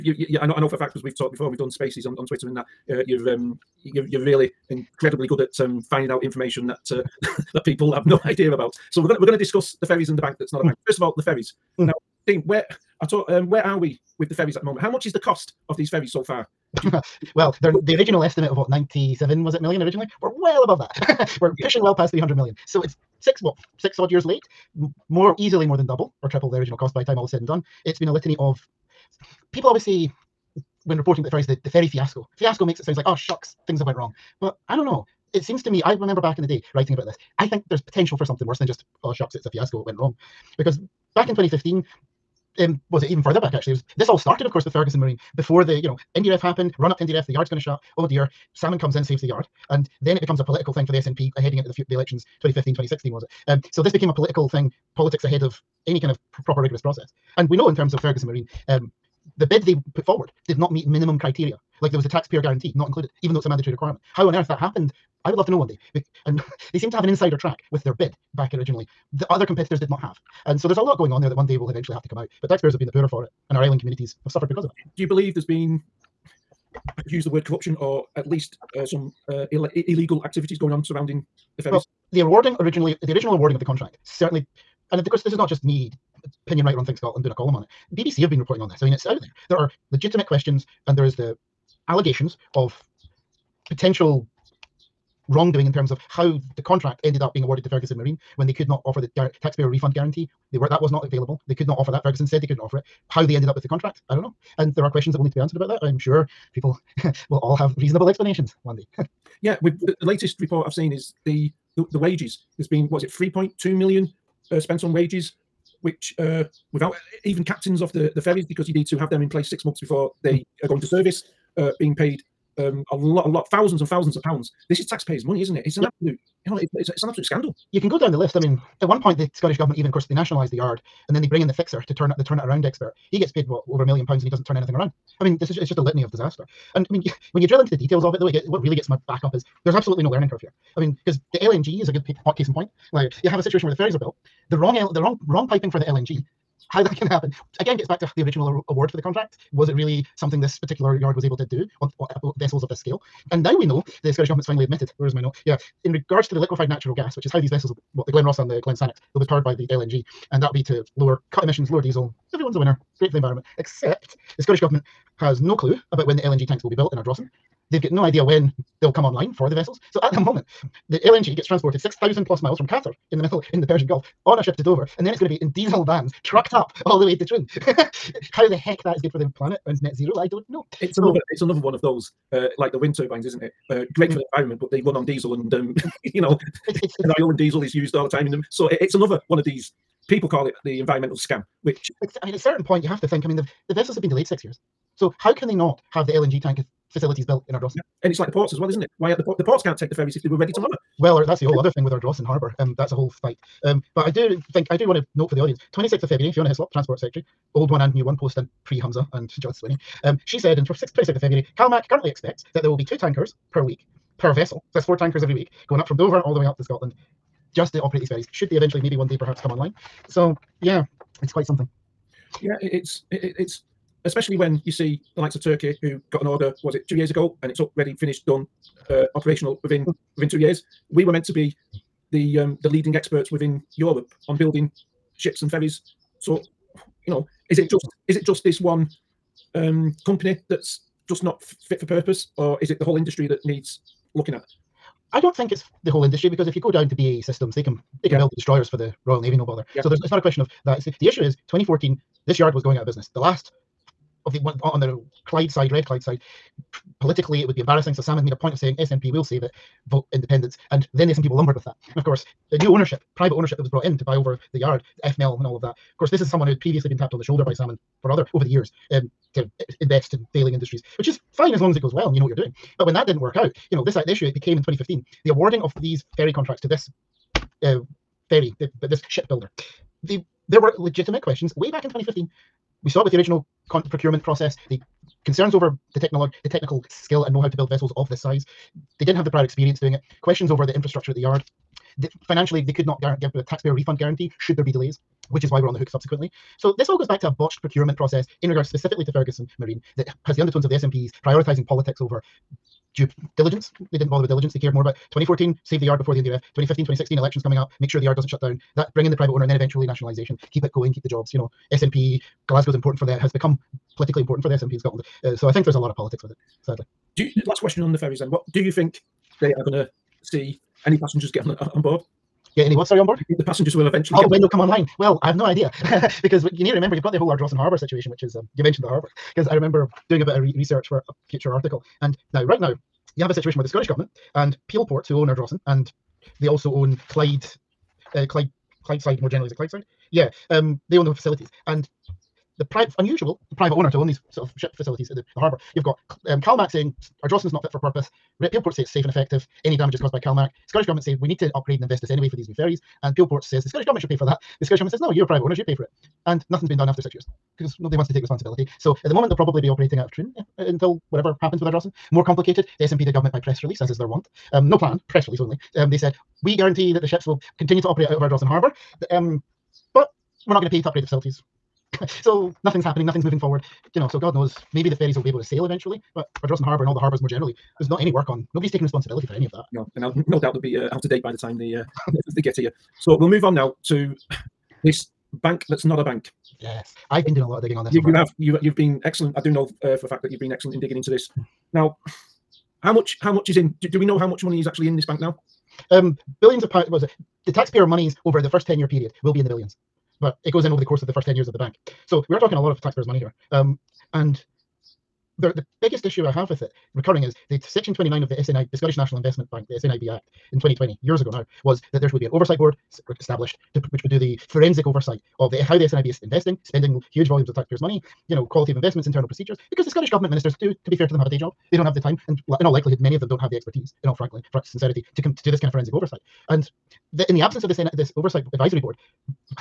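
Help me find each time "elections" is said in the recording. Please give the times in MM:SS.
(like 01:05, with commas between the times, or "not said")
00:51, 05:07.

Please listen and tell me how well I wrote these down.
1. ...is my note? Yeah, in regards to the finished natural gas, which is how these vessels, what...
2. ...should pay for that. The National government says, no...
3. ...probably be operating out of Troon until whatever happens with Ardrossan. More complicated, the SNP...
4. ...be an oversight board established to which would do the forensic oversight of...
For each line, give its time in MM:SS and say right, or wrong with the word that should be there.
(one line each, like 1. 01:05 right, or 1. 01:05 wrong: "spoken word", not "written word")
1. 02:35 wrong: "liquefied", not "finished"
2. 05:54 wrong: "Scottish", not "National"
3. 05:59 right
4. 06:52 right.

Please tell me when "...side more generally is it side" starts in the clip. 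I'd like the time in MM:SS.
05:39.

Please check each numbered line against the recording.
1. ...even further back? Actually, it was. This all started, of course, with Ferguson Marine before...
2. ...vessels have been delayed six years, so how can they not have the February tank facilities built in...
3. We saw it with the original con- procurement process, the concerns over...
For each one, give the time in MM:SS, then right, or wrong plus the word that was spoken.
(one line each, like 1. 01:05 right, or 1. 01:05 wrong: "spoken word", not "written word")
1. 00:43 right
2. 03:13 wrong: "LNG", not "February"
3. 04:42 right.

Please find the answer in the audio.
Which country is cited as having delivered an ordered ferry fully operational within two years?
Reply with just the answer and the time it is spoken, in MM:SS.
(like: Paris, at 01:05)
Turkey, at 03:45.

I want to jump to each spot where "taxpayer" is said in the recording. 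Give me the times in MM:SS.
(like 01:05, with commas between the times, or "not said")
01:02, 01:12, 01:39, 02:04, 04:53, 06:37, 06:42, 06:57.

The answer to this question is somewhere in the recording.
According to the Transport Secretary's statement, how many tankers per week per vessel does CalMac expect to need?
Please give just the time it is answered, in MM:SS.
03:32.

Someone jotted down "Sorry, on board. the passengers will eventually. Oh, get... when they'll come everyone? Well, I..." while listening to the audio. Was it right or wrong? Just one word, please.
wrong.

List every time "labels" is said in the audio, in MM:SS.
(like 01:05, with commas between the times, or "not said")
not said.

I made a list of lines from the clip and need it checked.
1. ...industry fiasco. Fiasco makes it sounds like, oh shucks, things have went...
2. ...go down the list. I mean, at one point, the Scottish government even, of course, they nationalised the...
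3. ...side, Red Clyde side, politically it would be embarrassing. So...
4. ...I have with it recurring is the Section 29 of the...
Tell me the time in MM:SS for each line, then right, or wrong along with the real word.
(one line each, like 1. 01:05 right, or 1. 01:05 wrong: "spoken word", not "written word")
1. 00:31 wrong: "ferry", not "industry"
2. 02:07 right
3. 04:15 right
4. 06:46 right.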